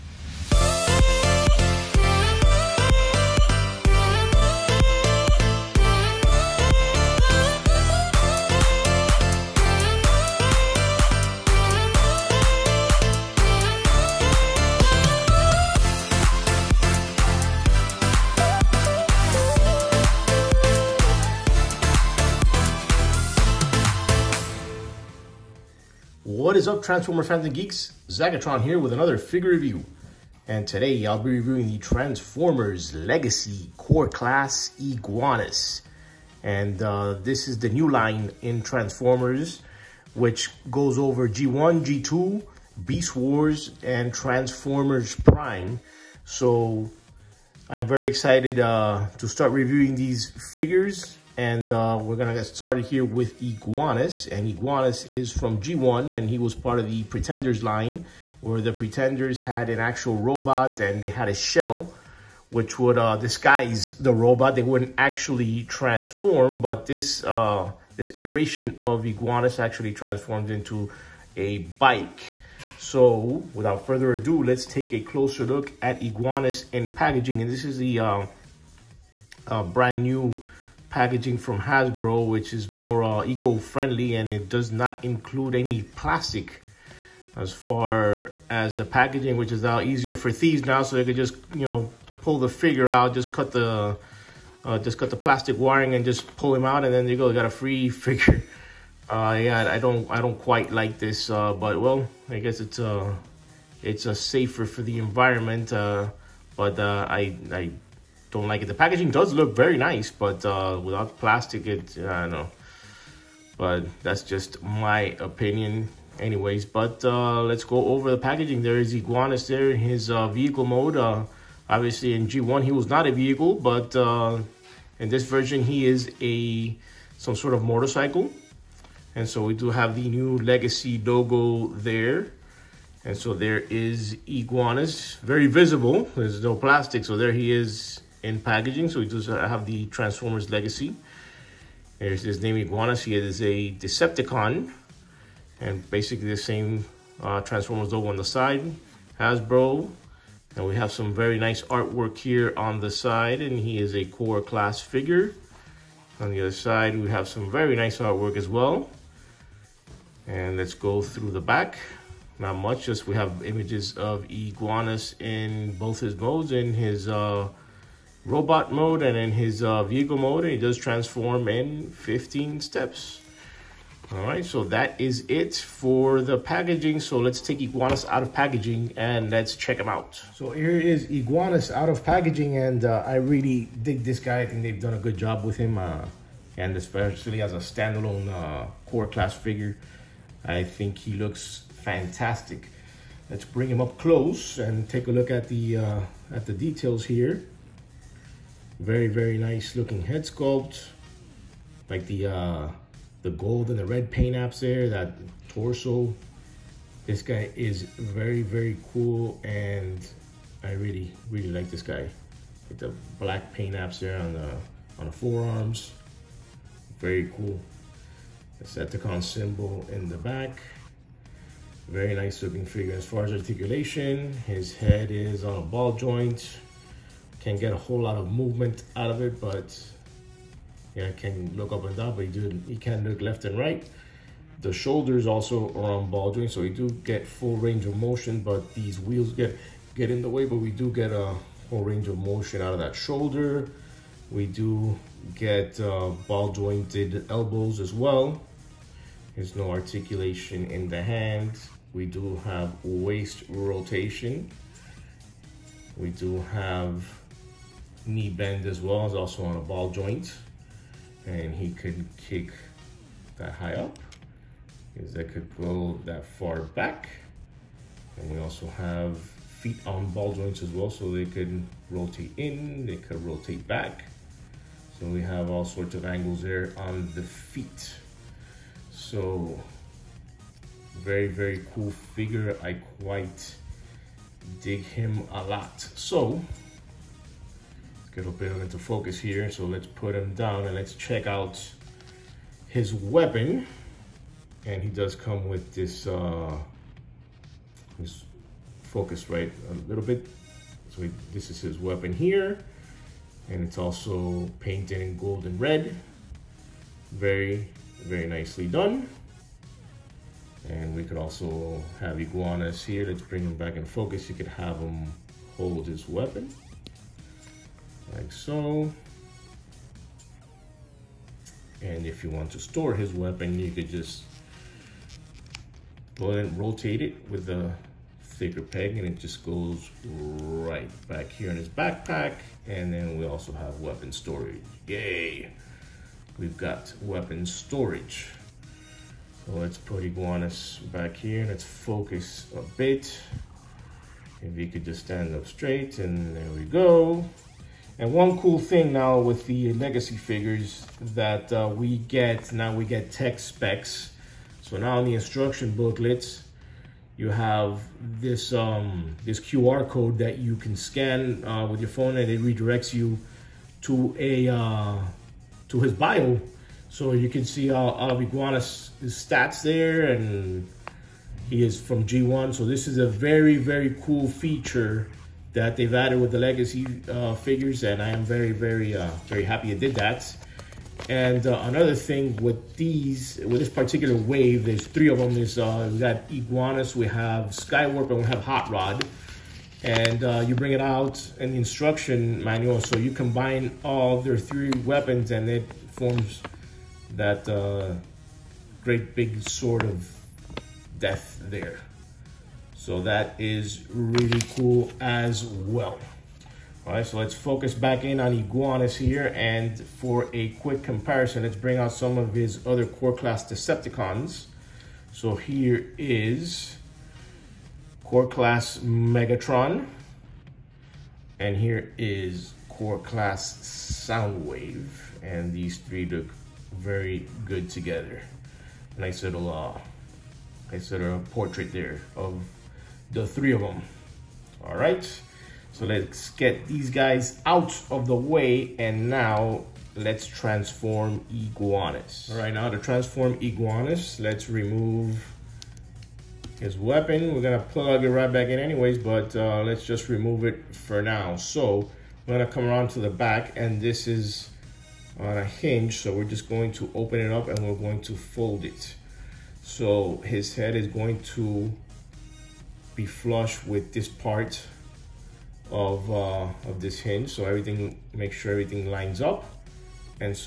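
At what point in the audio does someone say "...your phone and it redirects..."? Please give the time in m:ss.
6:01.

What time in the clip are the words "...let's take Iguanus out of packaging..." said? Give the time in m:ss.
2:57.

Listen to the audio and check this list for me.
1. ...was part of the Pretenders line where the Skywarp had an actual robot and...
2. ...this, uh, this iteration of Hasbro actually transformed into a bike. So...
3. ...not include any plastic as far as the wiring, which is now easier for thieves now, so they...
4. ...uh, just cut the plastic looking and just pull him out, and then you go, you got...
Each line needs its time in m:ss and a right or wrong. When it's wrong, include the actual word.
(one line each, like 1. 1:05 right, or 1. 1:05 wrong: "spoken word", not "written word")
1. 0:56 wrong: "Pretenders", not "Skywarp"
2. 1:06 wrong: "Iguanus", not "Hasbro"
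3. 1:24 wrong: "packaging", not "wiring"
4. 1:34 wrong: "wiring", not "looking".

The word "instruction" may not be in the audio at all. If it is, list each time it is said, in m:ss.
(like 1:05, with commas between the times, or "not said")
5:55, 6:31.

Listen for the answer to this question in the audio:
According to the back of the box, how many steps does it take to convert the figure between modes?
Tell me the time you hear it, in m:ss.
2:51.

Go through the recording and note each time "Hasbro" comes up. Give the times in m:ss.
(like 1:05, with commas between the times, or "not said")
1:21, 2:29.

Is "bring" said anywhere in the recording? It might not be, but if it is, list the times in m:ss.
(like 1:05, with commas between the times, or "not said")
3:13, 5:13, 6:30, 6:51.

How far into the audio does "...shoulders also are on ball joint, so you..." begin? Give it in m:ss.
3:54.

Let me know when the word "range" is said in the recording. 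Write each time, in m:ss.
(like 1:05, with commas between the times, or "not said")
3:57, 4:01.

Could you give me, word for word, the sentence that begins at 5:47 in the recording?
And one cool thing now with the legacy figures that uh, we get, now we get tech specs.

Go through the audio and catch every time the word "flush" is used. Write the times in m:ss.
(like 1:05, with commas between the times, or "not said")
7:43.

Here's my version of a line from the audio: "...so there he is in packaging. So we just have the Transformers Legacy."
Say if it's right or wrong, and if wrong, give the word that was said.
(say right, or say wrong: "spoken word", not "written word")
right.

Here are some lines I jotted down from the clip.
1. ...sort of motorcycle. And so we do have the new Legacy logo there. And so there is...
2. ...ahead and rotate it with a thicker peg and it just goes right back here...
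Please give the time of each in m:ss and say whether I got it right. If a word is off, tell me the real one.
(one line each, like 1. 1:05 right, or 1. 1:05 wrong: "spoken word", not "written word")
1. 2:07 right
2. 5:26 right.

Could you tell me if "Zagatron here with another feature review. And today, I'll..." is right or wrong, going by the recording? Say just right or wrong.
wrong.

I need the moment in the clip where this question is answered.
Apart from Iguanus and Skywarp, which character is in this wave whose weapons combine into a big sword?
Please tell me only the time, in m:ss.
6:28.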